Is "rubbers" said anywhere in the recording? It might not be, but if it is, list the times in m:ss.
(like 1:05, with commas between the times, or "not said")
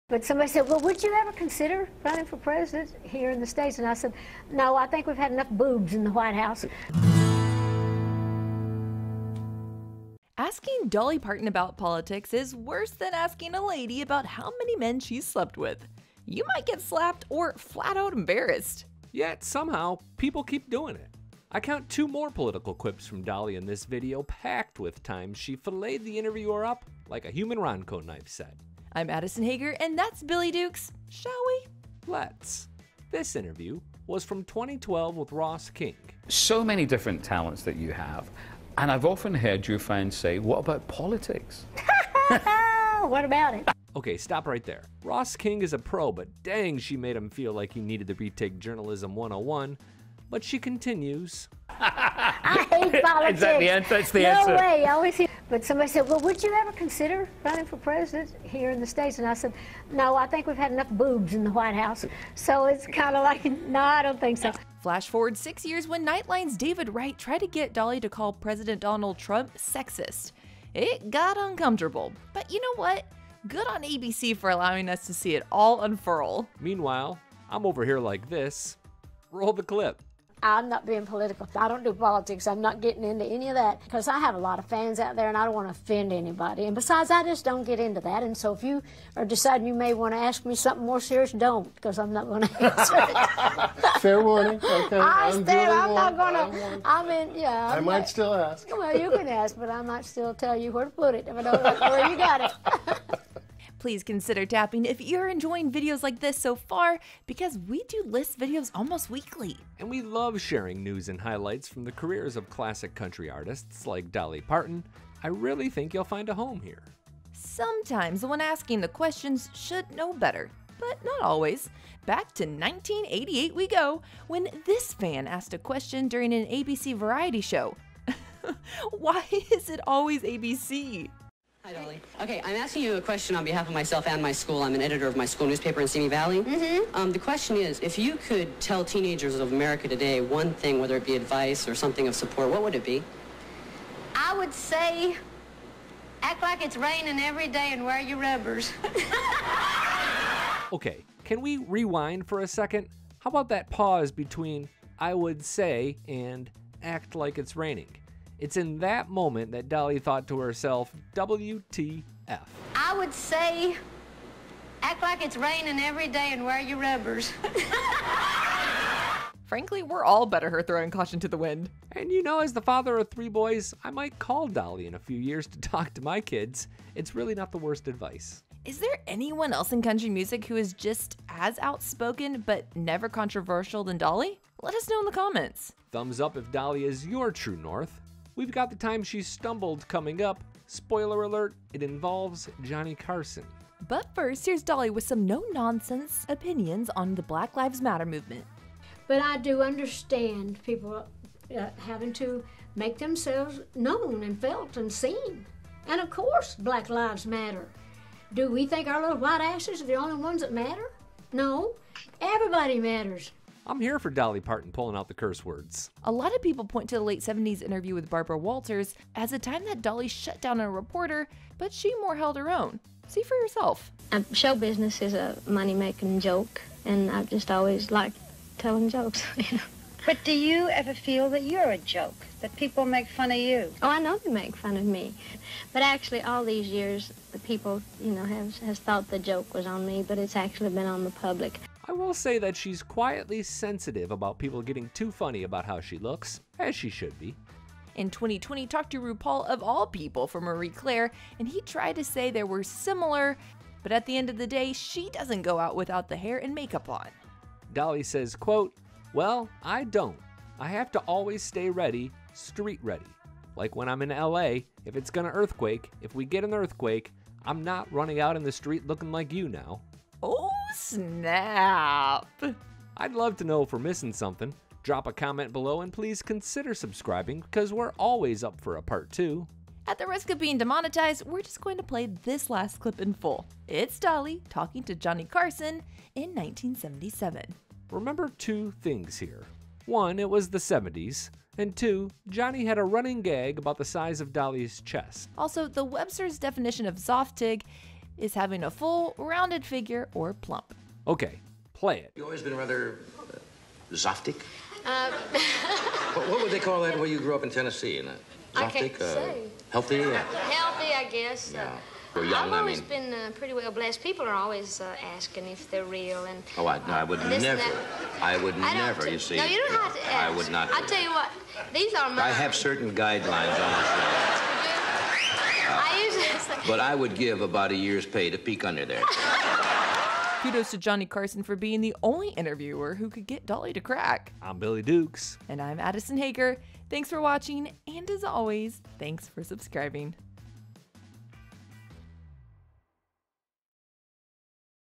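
2:28, 2:46.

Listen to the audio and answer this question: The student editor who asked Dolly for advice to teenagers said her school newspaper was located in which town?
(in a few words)
Simi Valley.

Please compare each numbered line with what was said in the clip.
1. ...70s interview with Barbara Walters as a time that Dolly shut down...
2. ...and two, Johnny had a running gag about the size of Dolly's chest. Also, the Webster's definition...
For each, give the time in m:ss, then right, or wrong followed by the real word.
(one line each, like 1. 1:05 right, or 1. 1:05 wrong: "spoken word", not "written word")
1. 3:37 right
2. 4:51 right.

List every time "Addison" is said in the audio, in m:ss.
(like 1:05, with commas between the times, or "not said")
0:29, 5:35.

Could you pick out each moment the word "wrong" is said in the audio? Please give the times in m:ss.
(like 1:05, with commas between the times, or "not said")
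not said.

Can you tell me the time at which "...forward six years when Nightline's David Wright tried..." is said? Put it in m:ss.
1:05.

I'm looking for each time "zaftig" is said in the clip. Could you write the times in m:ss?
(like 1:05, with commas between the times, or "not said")
4:56, 5:03, 5:08.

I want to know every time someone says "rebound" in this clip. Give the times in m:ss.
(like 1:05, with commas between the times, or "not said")
not said.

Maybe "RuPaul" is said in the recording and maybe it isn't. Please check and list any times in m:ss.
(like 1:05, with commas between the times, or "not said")
4:09.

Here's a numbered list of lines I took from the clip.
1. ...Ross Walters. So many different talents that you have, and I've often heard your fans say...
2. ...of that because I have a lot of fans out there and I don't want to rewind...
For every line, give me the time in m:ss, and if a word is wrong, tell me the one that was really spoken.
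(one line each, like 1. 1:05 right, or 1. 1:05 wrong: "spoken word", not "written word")
1. 0:35 wrong: "King", not "Walters"
2. 1:23 wrong: "offend", not "rewind".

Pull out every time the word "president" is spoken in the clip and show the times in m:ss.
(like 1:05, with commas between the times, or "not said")
0:02, 0:57, 1:08.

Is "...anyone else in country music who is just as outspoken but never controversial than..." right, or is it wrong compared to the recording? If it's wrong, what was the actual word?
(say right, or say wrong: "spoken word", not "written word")
right.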